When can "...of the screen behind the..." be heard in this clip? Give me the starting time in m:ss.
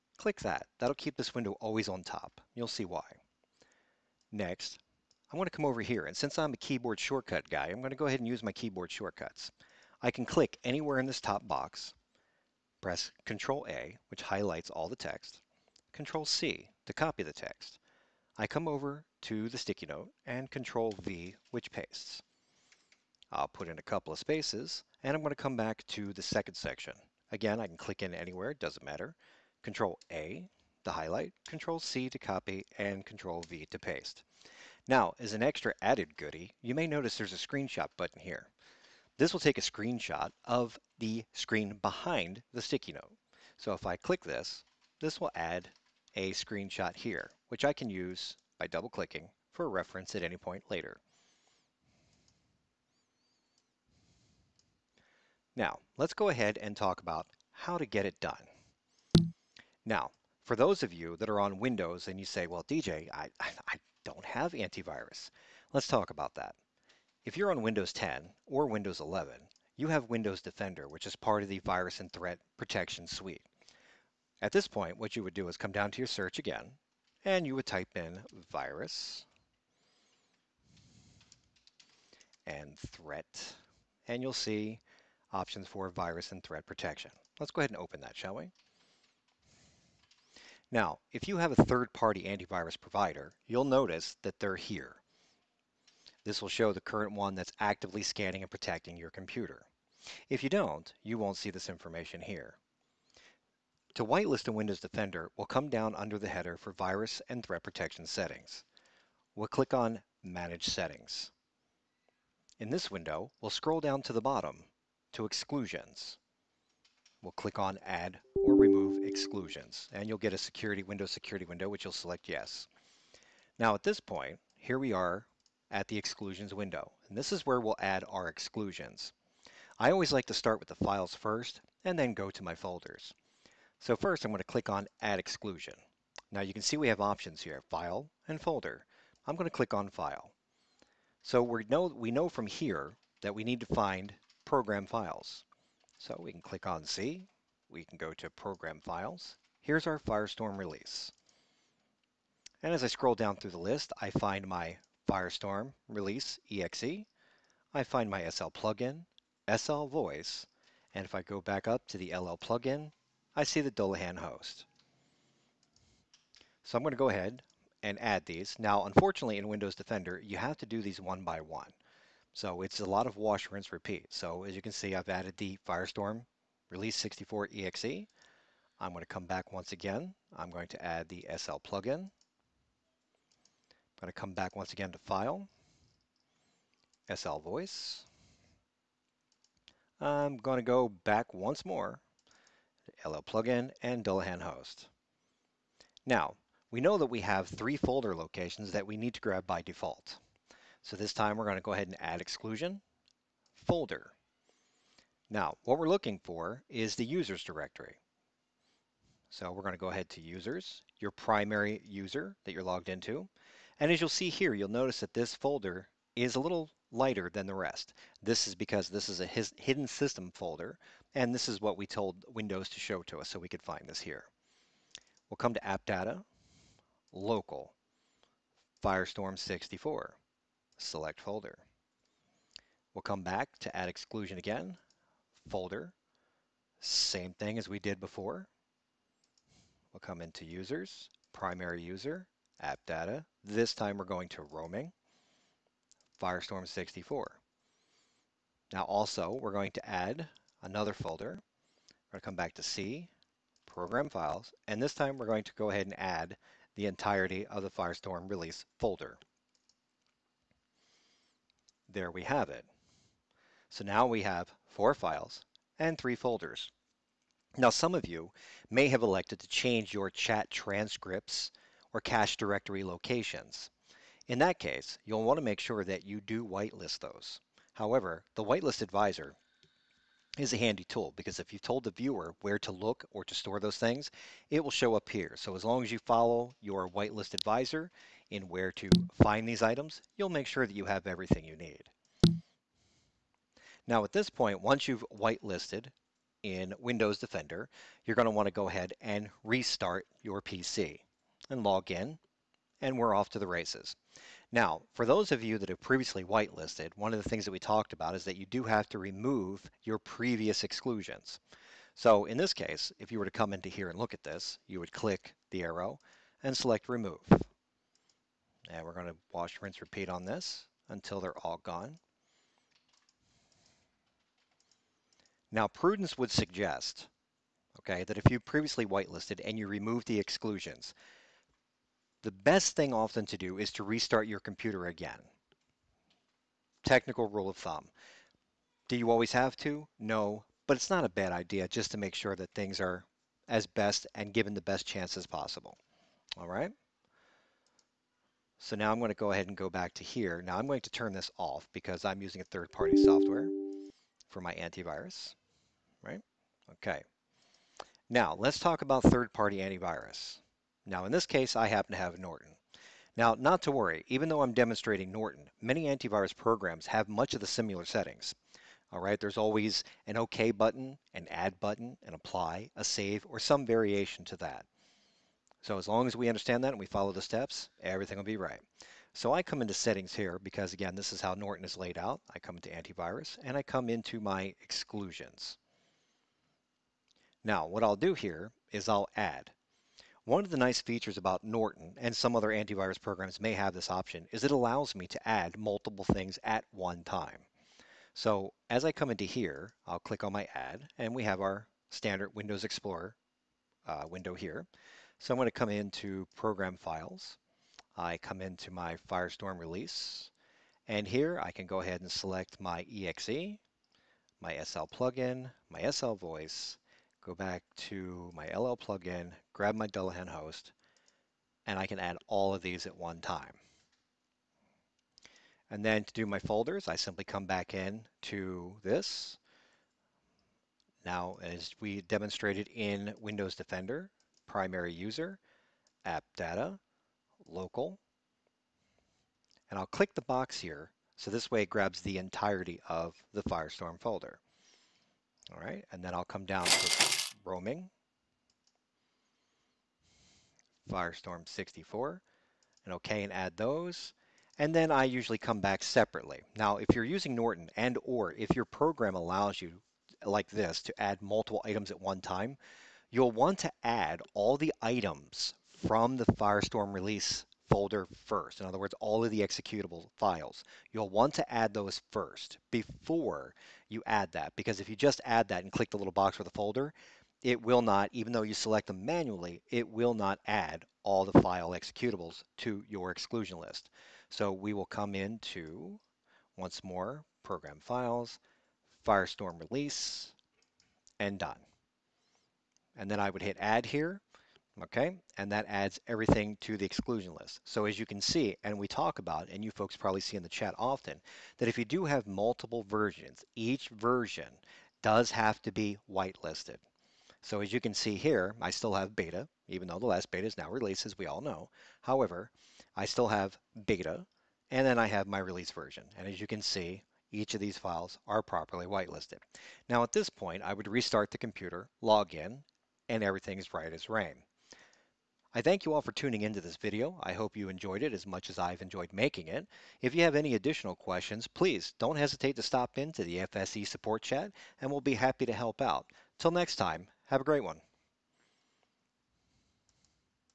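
0:40.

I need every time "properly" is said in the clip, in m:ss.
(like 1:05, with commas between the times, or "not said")
8:38.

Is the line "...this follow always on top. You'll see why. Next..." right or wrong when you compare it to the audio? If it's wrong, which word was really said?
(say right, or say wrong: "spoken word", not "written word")
wrong: "window", not "follow".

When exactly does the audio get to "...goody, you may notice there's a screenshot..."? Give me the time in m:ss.
0:36.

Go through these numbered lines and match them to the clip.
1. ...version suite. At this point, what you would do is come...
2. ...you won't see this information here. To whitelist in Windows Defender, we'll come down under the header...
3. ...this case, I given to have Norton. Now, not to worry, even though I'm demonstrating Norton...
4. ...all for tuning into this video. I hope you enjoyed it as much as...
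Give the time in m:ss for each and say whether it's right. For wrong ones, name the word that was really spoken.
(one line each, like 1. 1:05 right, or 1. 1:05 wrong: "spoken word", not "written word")
1. 1:12 wrong: "protection", not "version"
2. 1:41 right
3. 6:01 wrong: "happen", not "given"
4. 8:45 right.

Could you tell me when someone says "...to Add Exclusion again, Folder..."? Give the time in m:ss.
3:53.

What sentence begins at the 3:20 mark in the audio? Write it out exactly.
So this time we're going to go ahead and add exclusion, folder.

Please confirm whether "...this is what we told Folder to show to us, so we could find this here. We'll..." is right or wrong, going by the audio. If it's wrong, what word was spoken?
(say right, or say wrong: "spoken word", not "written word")
wrong: "Windows", not "Folder".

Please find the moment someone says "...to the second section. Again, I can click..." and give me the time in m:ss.
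0:25.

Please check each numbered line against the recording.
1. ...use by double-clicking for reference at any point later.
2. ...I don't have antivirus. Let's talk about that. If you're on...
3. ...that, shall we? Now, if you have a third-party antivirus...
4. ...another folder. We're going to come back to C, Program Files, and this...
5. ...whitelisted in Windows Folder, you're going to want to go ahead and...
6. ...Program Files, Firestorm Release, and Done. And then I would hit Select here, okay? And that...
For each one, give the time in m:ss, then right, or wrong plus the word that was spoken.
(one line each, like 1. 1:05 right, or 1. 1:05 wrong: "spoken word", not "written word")
1. 0:47 right
2. 1:03 right
3. 1:28 right
4. 4:10 right
5. 4:55 wrong: "Defender", not "Folder"
6. 8:07 wrong: "Add", not "Select".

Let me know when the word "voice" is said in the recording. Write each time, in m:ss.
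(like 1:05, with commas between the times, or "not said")
2:39, 3:07, 6:56.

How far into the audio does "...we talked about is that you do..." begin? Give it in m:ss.
5:07.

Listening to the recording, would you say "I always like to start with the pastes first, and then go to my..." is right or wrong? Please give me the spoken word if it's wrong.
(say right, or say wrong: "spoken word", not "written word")
wrong: "files", not "pastes".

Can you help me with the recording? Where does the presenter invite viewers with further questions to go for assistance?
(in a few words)
FSE support chat.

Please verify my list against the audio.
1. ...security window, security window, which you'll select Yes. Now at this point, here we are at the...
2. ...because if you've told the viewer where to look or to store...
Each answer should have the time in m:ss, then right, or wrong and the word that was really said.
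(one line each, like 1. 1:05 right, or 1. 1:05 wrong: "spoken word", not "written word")
1. 2:00 right
2. 4:41 right.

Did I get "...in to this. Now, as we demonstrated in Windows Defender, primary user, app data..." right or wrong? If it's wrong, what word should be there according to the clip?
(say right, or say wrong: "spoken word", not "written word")
right.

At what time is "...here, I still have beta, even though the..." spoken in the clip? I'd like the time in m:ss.
8:28.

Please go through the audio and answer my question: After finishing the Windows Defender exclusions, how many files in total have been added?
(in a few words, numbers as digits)
4.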